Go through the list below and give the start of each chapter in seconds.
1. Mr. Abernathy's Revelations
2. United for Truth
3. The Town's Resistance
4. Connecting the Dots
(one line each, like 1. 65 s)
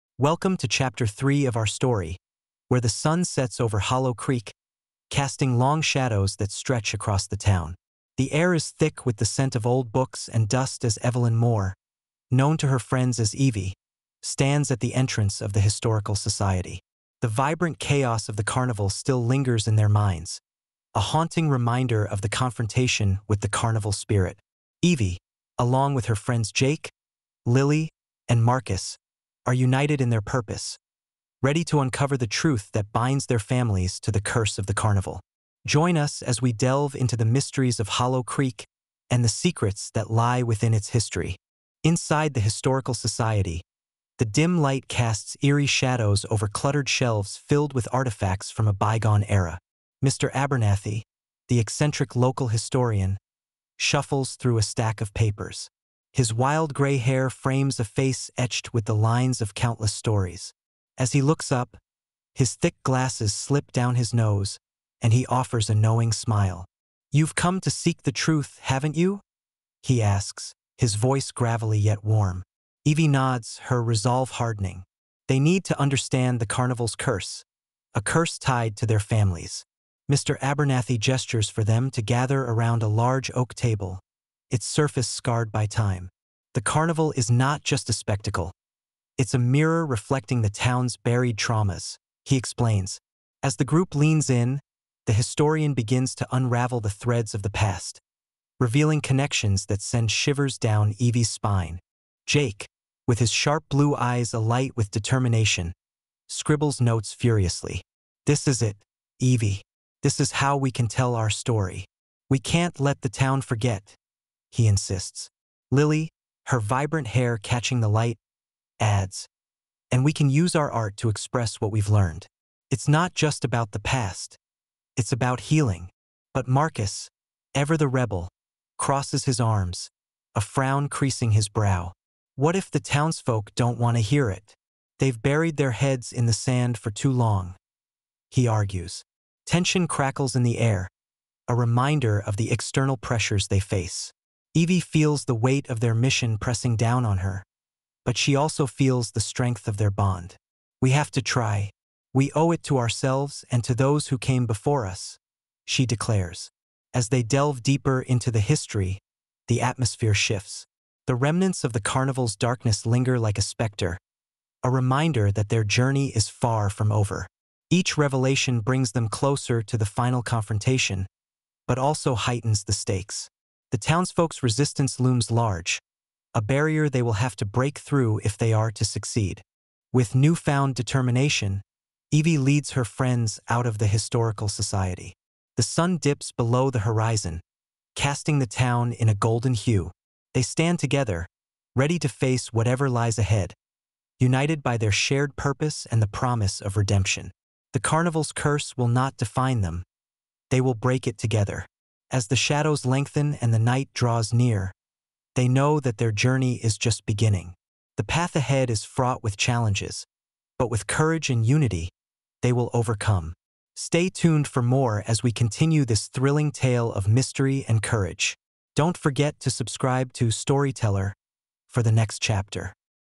1. 45 s
2. 165 s
3. 135 s
4. 90 s.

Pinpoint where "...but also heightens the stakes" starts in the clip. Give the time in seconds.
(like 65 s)
171 s.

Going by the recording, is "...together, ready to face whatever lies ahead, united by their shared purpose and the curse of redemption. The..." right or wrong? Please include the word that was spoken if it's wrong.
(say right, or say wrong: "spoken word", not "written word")
wrong: "promise", not "curse".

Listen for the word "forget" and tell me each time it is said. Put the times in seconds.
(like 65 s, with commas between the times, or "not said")
113 s, 218 s.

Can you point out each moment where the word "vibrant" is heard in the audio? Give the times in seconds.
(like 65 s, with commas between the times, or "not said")
17 s, 116 s.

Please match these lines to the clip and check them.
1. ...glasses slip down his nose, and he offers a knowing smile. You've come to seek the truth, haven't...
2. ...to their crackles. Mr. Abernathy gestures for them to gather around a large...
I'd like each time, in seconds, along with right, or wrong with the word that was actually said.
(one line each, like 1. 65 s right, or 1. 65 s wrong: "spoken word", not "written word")
1. 62 s right
2. 78 s wrong: "families", not "crackles".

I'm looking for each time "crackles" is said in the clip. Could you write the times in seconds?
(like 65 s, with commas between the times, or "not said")
139 s.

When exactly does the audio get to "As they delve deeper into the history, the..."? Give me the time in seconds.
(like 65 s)
156 s.